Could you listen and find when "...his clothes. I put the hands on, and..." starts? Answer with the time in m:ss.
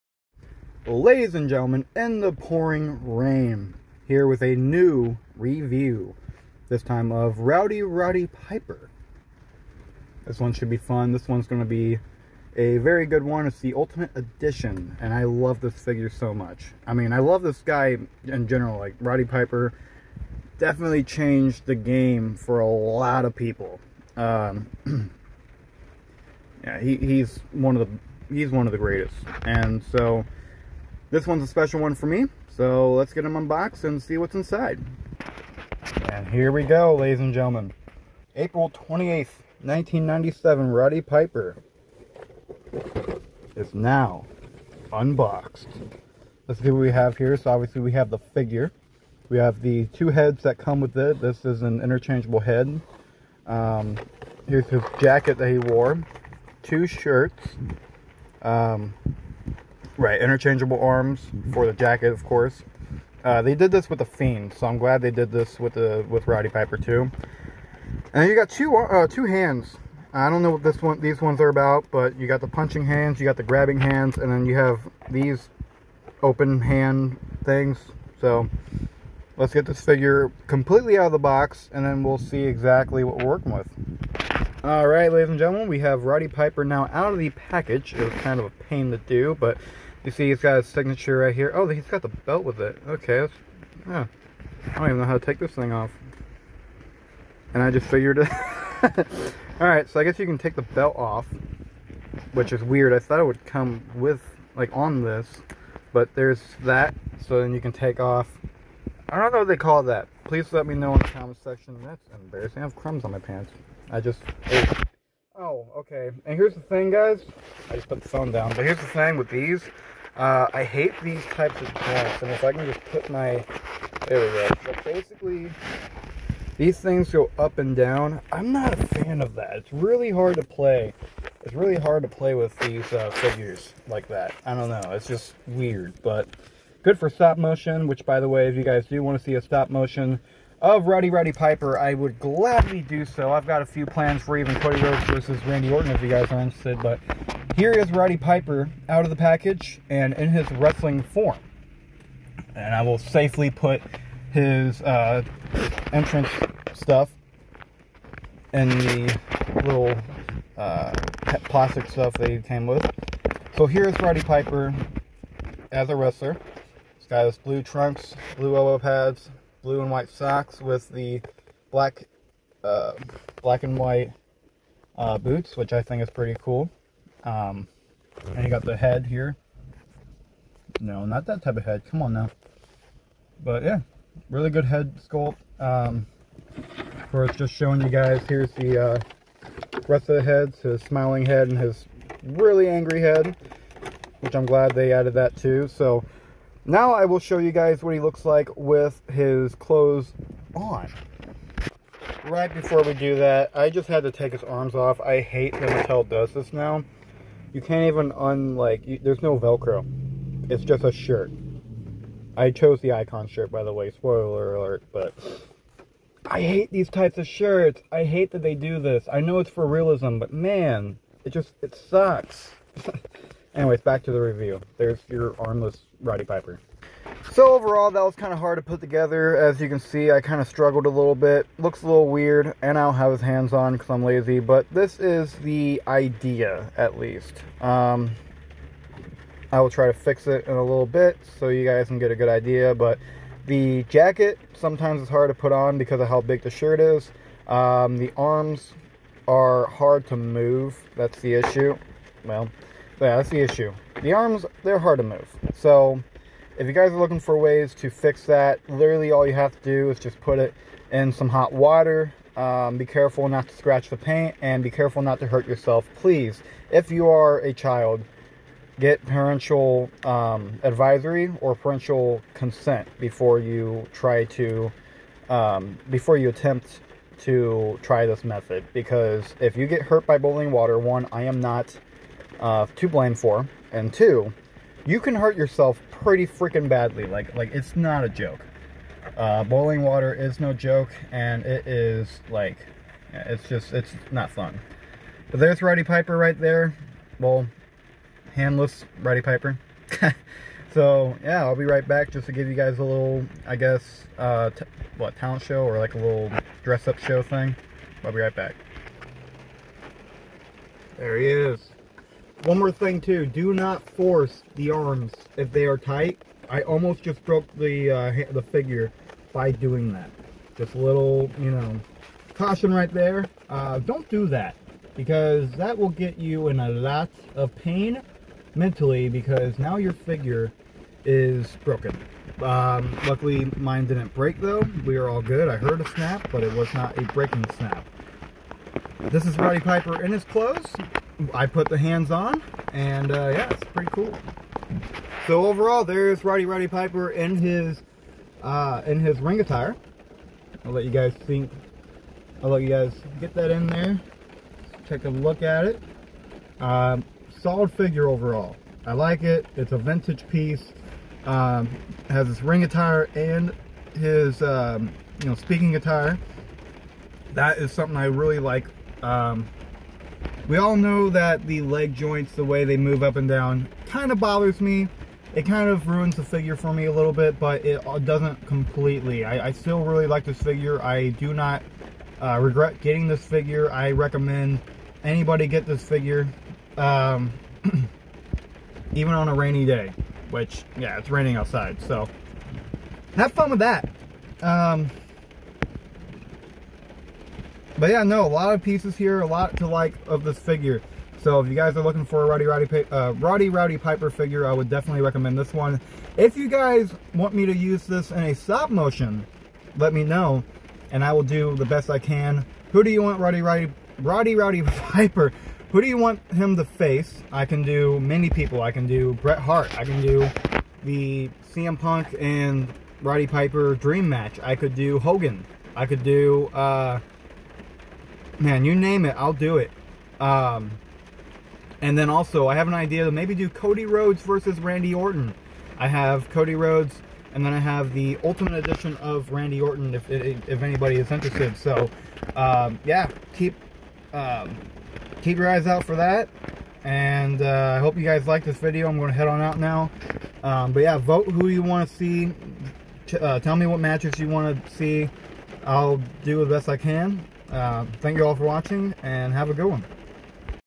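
5:40.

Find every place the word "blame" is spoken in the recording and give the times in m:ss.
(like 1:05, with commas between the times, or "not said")
4:42.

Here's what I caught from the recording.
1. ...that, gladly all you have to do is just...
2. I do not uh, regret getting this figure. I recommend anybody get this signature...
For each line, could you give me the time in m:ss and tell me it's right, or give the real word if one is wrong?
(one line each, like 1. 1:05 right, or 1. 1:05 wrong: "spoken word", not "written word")
1. 4:18 wrong: "literally", not "gladly"
2. 6:20 wrong: "figure", not "signature".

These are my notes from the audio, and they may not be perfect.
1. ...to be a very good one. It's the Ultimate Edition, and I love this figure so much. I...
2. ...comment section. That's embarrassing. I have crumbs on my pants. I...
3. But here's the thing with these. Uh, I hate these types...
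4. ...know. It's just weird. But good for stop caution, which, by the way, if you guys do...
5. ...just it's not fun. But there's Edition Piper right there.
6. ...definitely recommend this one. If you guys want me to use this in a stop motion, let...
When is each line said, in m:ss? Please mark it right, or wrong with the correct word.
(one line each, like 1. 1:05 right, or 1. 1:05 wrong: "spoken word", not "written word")
1. 0:11 right
2. 1:51 right
3. 1:58 right
4. 2:14 wrong: "motion", not "caution"
5. 4:53 wrong: "Roddy", not "Edition"
6. 6:44 right.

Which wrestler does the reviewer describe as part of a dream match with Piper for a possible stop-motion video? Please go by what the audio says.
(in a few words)
CM Punk.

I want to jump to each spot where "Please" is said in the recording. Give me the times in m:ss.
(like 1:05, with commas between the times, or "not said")
1:50, 4:25.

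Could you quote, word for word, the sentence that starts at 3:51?
Looks a little weird, and I don't have his hands on because I'm lazy, but this is the idea, at least.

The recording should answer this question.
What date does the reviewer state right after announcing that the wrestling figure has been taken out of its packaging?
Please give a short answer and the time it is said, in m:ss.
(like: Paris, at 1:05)
April 28th, 1997, at 0:38.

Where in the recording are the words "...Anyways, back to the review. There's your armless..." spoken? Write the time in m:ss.
3:43.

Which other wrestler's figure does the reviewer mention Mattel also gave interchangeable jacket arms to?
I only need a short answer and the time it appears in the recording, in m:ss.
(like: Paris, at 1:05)
The Fiend, at 1:03.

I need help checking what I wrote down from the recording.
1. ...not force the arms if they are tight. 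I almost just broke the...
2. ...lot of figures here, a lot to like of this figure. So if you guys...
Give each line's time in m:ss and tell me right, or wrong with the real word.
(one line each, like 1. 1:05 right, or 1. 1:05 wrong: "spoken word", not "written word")
1. 5:13 right
2. 6:38 wrong: "pieces", not "figures".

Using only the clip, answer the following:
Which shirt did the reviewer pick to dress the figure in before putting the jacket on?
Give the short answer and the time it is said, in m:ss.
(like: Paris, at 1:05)
The Icon shirt, at 3:32.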